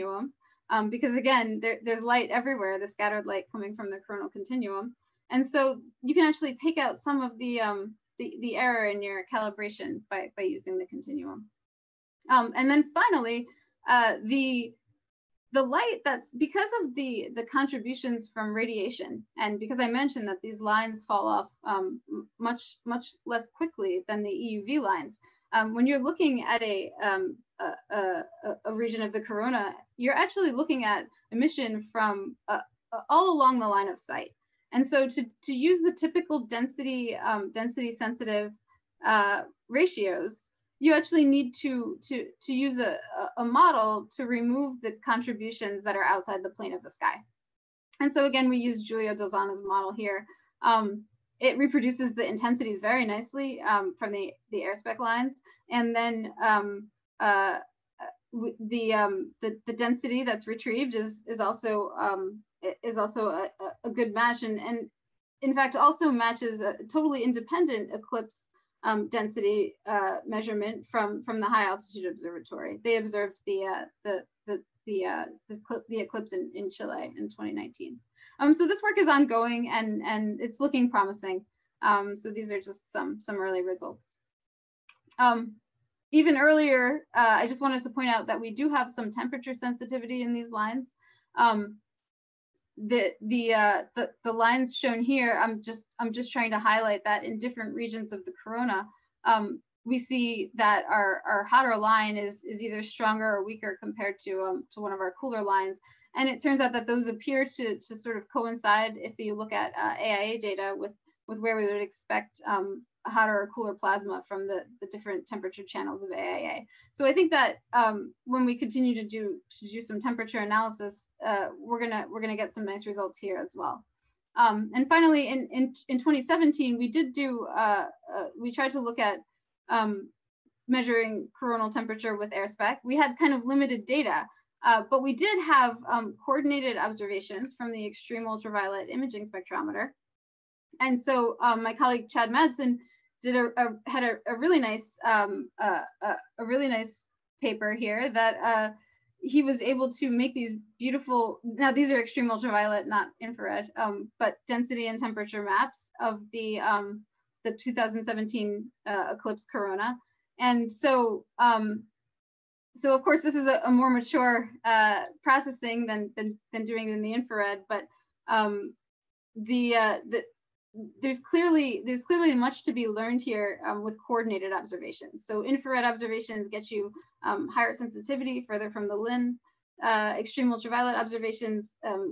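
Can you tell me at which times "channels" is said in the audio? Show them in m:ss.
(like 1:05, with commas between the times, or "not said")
1:55.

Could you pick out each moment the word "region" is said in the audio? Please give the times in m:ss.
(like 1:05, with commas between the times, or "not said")
0:28, 1:37.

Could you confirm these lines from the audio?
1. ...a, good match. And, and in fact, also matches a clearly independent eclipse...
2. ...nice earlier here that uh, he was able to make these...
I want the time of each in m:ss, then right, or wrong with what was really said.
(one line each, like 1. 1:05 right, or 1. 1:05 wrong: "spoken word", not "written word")
1. 1:03 wrong: "totally", not "clearly"
2. 2:26 wrong: "paper", not "earlier".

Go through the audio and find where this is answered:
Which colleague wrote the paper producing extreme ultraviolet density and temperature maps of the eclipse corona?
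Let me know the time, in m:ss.
2:22.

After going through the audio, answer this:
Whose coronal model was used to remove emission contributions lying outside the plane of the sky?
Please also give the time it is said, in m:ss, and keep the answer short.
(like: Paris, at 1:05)
Giulio Del Zanna, at 0:48.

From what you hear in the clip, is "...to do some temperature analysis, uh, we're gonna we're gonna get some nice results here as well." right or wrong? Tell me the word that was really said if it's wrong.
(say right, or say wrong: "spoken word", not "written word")
right.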